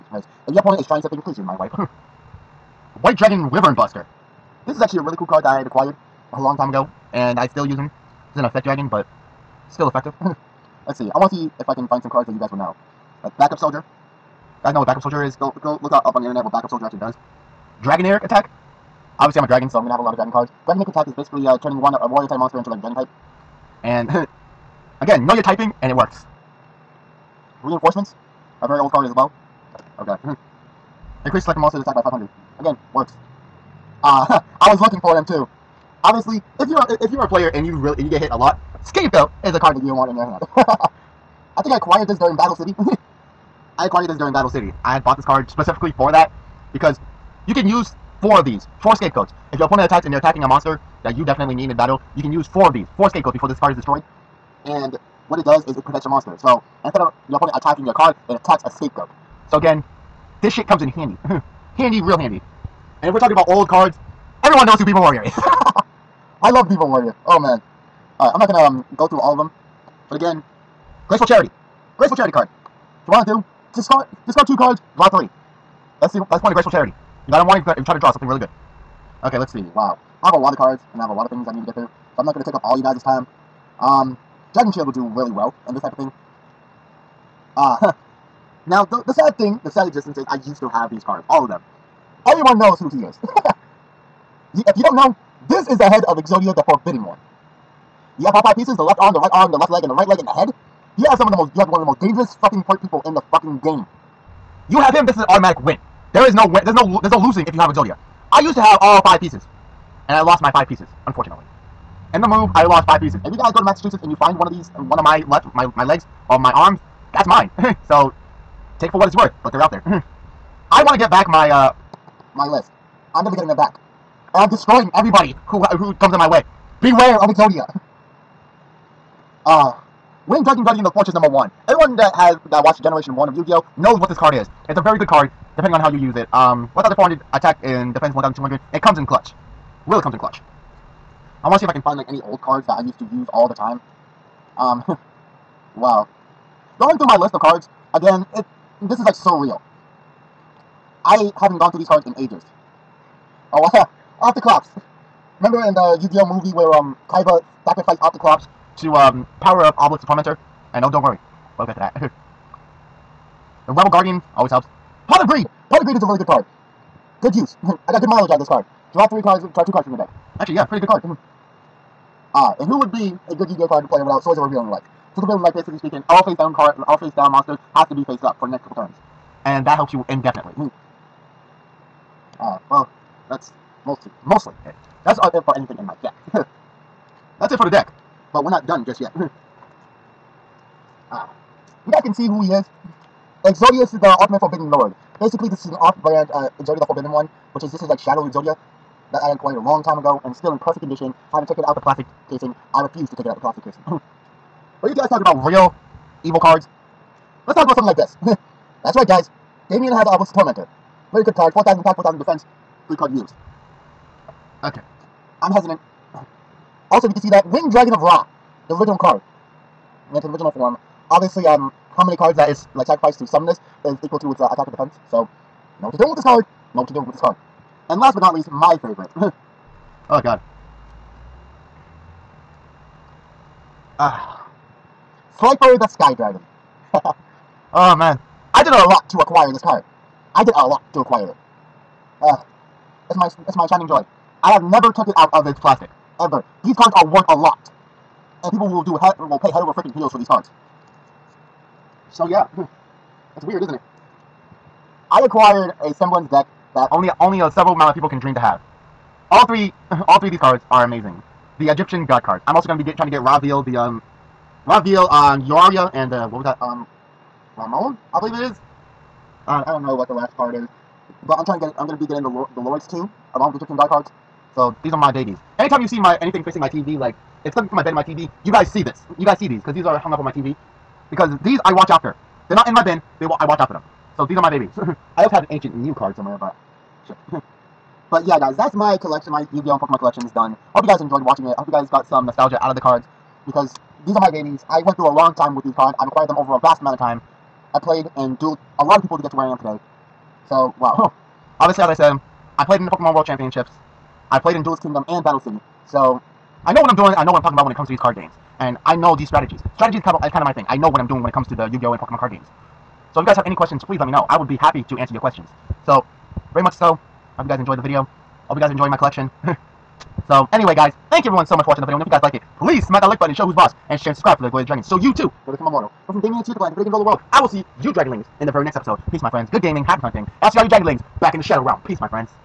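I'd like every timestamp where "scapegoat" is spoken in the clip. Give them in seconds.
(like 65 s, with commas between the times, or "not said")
38 s, 48 s, 53 s, 58 s.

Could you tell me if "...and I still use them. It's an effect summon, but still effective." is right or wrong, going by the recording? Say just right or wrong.
wrong.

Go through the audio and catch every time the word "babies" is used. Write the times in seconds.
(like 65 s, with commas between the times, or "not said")
275 s, 284 s, 294 s.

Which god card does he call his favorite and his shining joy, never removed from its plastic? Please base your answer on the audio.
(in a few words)
Slifer the Sky Dragon.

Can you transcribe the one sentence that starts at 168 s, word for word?
Draw three cards, try two cards from your deck.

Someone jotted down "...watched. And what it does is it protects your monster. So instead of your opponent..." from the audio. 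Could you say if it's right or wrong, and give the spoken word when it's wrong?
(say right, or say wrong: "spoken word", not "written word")
wrong: "destroyed", not "watched".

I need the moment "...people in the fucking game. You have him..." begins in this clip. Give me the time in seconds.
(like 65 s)
102 s.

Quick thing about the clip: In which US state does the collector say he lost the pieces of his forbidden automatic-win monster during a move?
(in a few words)
Massachusetts.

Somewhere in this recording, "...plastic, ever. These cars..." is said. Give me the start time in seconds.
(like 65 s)
245 s.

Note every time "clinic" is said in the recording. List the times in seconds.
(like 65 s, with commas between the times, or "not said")
not said.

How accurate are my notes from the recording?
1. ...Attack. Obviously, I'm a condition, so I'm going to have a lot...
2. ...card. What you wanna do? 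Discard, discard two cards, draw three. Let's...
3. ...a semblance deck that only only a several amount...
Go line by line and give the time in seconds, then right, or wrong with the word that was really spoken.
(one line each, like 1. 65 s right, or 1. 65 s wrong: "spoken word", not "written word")
1. 18 s wrong: "dragon", not "condition"
2. 72 s right
3. 255 s right.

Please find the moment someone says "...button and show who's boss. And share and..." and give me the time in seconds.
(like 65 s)
323 s.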